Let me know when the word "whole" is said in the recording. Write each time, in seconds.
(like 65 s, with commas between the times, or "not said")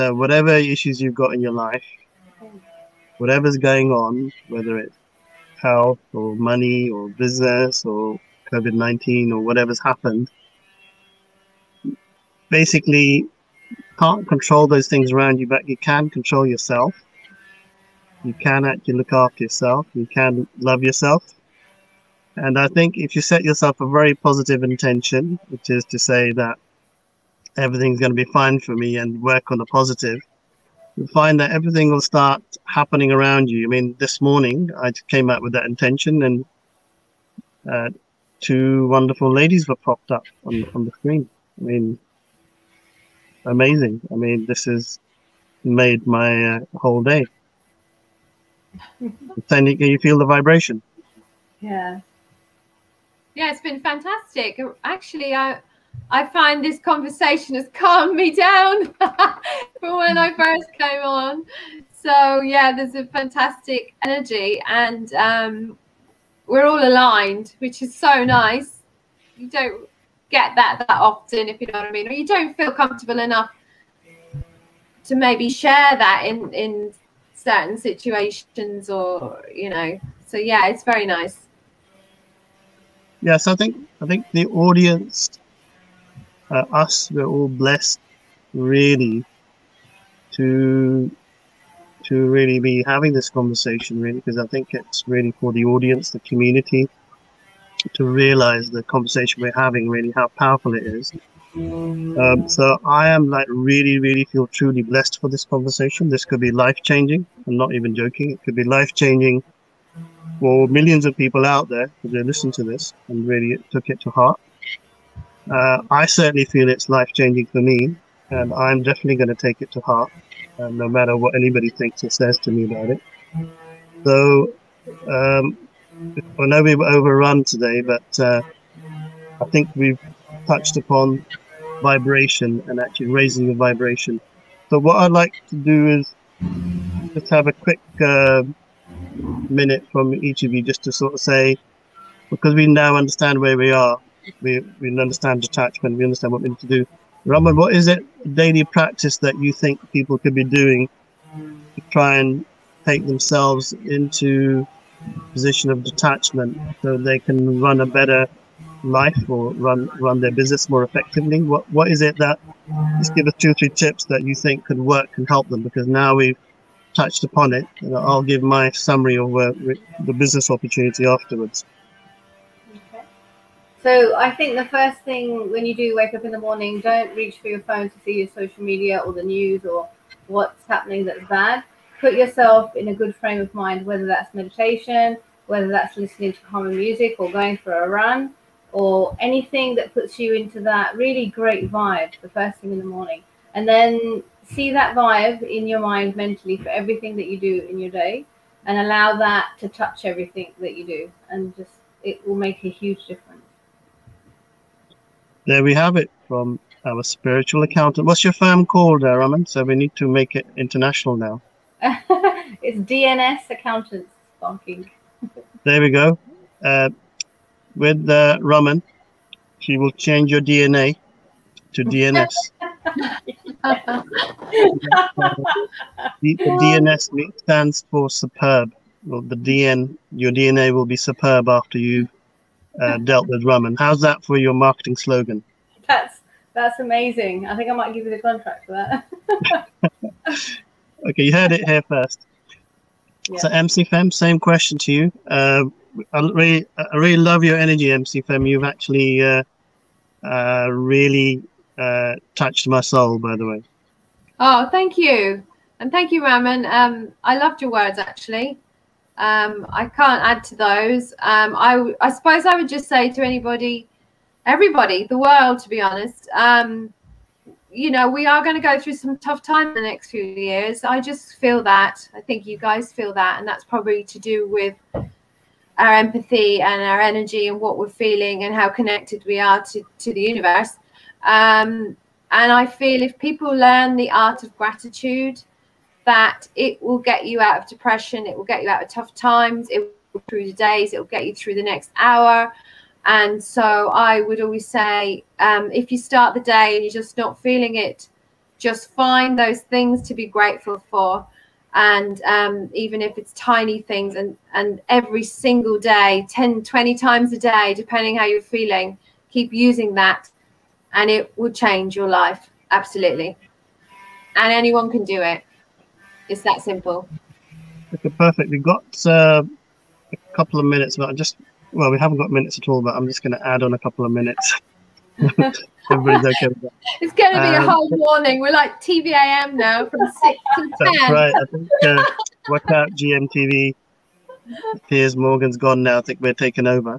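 46 s, 327 s.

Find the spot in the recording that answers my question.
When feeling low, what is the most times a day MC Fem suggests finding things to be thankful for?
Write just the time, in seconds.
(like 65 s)
306 s.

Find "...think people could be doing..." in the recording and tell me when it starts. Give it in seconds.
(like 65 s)
149 s.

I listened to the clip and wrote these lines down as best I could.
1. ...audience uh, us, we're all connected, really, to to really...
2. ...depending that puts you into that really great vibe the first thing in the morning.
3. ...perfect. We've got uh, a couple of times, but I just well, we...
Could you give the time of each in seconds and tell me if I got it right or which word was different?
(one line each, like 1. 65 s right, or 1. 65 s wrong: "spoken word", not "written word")
1. 84 s wrong: "blessed", not "connected"
2. 189 s wrong: "anything", not "depending"
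3. 318 s wrong: "minutes", not "times".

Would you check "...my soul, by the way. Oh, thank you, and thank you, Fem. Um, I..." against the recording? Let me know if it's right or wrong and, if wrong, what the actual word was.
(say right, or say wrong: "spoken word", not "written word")
wrong: "Raman", not "Fem".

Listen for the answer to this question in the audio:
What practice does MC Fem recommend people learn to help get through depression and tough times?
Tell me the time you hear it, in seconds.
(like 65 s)
284 s.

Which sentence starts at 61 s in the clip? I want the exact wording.
So yeah, there's a fantastic energy, and um, we're all aligned, which is so nice.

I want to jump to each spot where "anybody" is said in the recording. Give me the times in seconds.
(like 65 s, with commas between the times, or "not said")
121 s, 263 s.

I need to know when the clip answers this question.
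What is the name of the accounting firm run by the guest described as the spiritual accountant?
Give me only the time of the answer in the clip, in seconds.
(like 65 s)
212 s.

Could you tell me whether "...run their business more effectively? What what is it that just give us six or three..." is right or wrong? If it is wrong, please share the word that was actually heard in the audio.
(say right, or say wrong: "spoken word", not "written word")
wrong: "two", not "six".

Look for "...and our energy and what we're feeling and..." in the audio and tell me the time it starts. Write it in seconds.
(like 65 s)
276 s.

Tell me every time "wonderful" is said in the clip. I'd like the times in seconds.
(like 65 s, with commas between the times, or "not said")
38 s.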